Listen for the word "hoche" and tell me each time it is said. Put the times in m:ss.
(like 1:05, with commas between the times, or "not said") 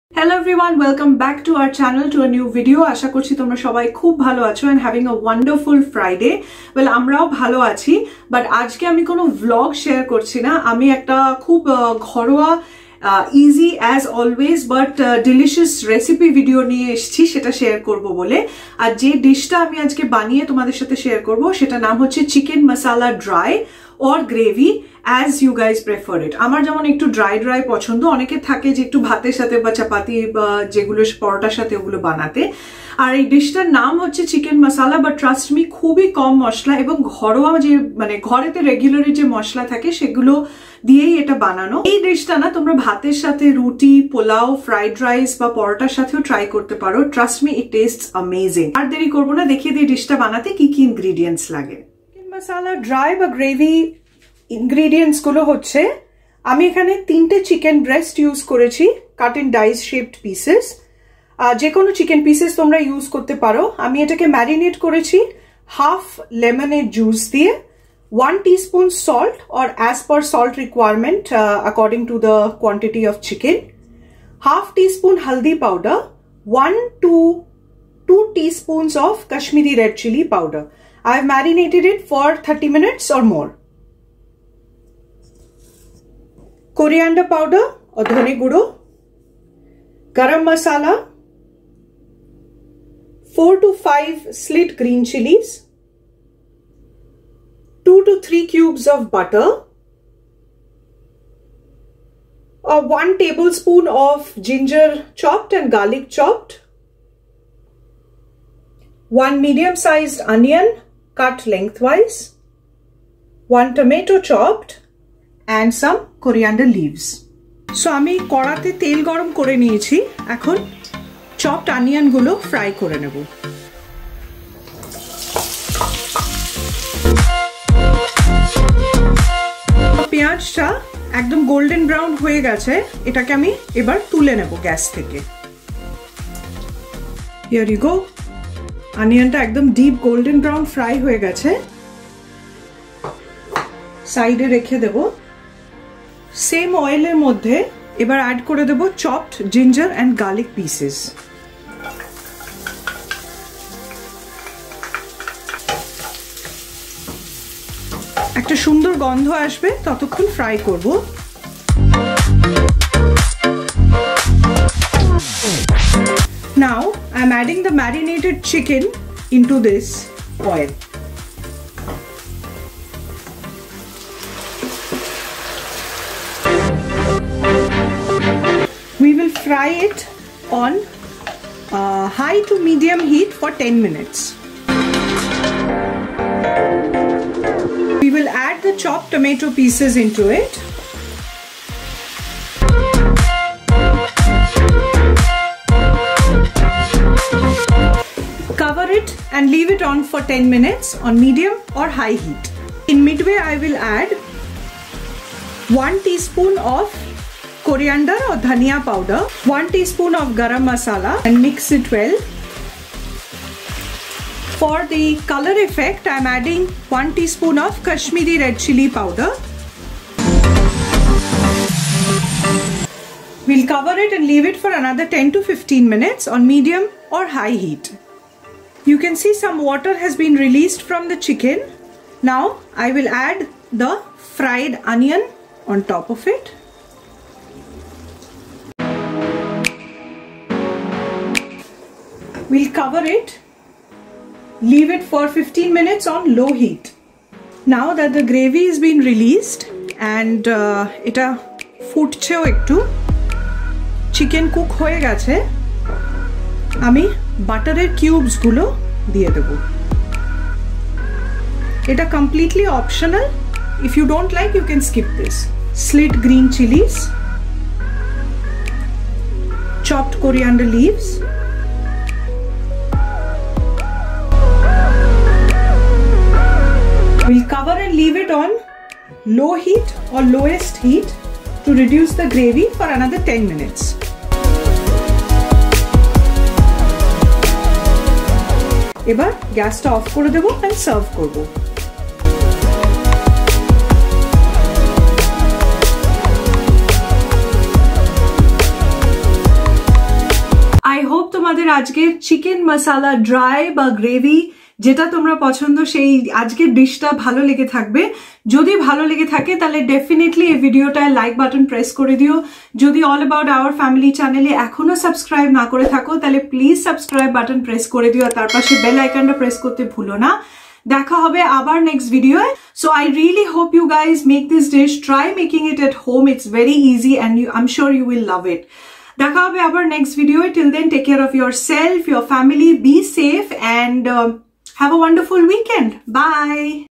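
0:55.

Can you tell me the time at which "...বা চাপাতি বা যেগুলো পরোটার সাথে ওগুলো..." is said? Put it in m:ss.
0:29.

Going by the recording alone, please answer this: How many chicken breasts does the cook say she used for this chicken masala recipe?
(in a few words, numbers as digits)
3.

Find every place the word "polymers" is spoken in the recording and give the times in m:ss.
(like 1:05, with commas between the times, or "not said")
not said.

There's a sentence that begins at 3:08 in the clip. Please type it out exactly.
We will add the chopped tomato pieces into it.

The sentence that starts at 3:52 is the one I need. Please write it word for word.
Now I will add the fried onion on top of it.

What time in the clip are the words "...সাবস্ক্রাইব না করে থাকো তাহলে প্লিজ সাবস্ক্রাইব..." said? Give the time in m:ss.
5:15.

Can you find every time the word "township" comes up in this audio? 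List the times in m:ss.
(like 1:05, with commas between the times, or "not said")
not said.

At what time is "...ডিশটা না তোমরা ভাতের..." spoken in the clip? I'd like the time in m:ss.
0:42.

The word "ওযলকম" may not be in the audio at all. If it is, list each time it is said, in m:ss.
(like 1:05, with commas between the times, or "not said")
0:00.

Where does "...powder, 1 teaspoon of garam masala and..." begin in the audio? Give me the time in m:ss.
3:28.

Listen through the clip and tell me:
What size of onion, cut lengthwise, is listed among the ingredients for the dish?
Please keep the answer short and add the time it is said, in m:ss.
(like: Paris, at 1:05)
Medium sized, at 1:49.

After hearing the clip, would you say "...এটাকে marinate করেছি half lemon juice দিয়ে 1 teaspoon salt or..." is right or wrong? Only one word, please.
right.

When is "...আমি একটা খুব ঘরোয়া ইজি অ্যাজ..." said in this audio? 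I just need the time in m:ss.
0:10.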